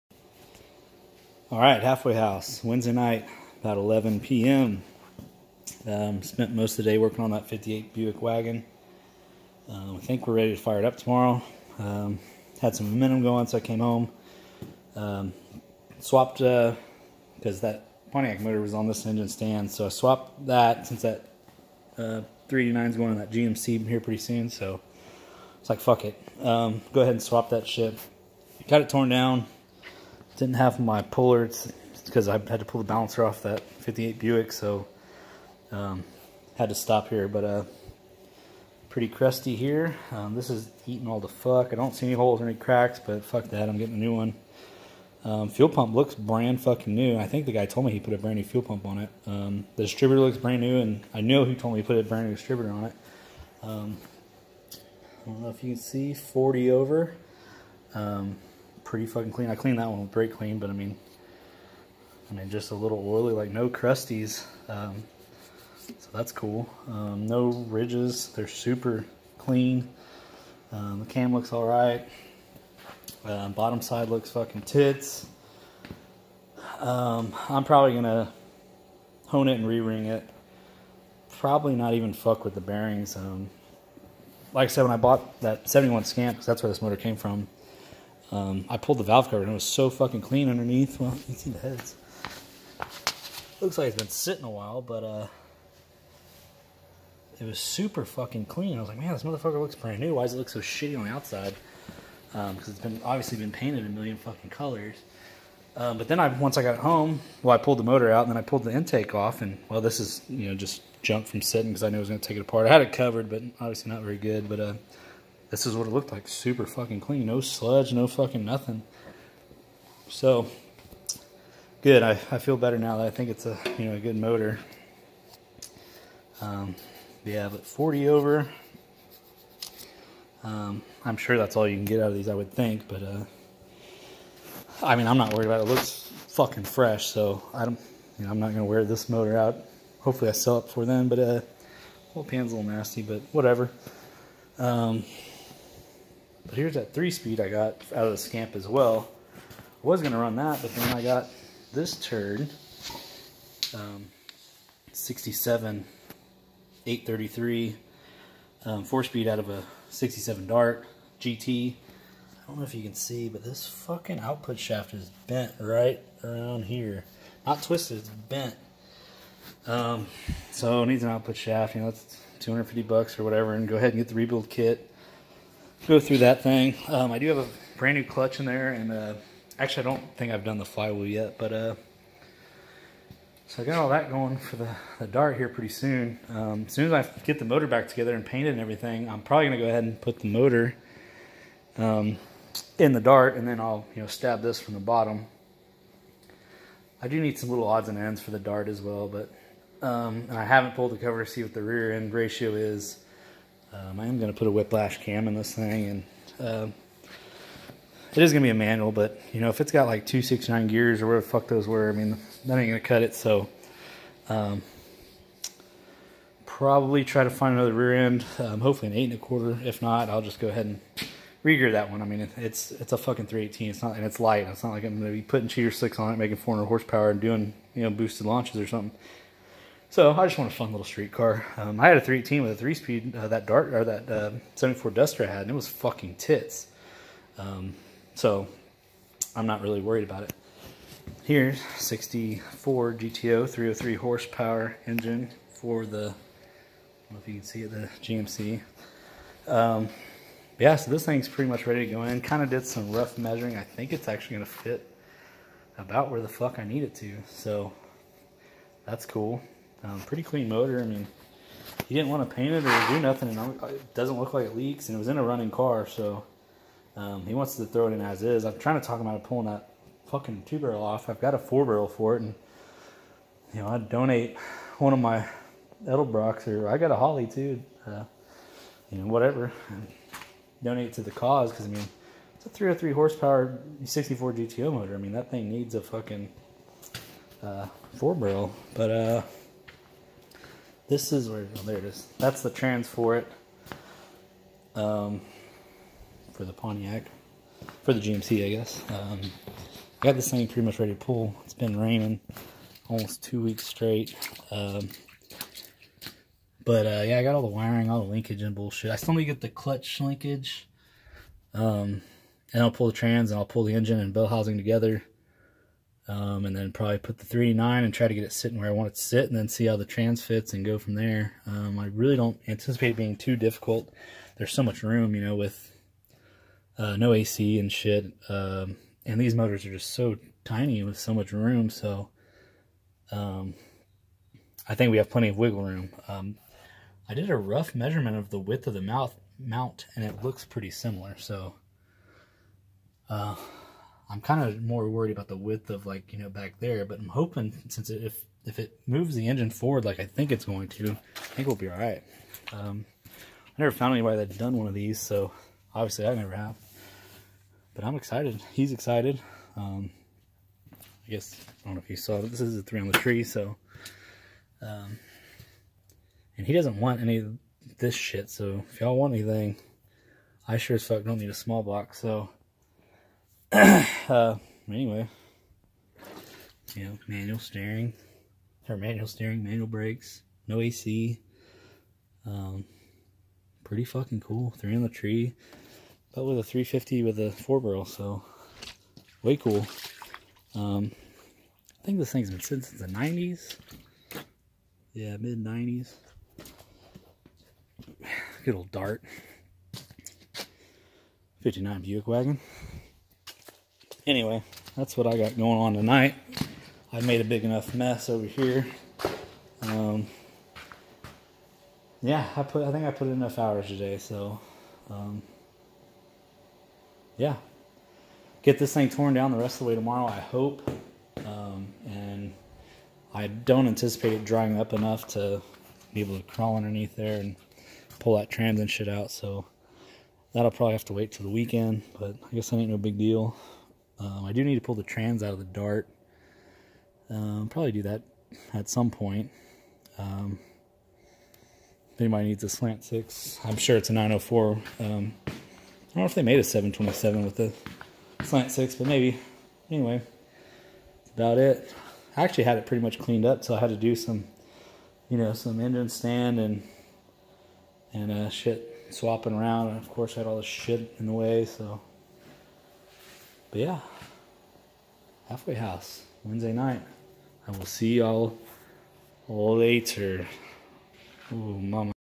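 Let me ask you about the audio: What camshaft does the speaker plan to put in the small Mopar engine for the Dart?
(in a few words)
Whiplash.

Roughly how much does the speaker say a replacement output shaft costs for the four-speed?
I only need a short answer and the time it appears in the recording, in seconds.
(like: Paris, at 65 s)
250 bucks, at 172 s.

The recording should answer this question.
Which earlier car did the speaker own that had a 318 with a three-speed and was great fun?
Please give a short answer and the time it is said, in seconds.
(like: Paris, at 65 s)
74 Duster, at 234 s.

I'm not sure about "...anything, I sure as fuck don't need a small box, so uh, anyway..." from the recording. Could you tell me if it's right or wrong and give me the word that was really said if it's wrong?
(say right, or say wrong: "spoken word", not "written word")
right.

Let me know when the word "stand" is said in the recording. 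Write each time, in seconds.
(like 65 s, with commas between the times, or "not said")
19 s, 455 s.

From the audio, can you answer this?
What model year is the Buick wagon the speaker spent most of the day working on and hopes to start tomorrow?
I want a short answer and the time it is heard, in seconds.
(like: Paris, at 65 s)
58, at 7 s.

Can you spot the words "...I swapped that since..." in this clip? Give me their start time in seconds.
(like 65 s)
19 s.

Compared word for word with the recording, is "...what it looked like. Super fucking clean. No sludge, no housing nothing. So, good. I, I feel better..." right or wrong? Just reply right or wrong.
wrong.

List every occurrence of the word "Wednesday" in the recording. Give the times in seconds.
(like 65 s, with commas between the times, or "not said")
2 s, 466 s.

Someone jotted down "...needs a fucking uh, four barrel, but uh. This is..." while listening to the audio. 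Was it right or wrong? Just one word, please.
right.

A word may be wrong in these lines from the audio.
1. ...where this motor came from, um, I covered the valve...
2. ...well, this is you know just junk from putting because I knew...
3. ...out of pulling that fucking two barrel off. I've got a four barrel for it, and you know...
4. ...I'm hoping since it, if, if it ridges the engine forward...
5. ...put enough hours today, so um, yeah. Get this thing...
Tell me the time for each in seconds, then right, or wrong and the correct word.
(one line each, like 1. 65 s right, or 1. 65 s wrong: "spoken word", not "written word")
1. 86 s wrong: "pulled", not "covered"
2. 109 s wrong: "sitting", not "putting"
3. 269 s right
4. 346 s wrong: "moves", not "ridges"
5. 412 s right.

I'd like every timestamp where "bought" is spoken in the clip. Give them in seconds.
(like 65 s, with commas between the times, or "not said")
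84 s.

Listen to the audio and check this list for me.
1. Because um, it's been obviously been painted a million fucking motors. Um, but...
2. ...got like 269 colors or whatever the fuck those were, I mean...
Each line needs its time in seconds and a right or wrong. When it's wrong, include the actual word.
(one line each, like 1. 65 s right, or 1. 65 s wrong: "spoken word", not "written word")
1. 102 s wrong: "colors", not "motors"
2. 209 s wrong: "gears", not "colors".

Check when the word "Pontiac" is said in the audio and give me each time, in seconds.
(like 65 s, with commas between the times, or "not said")
18 s, 296 s.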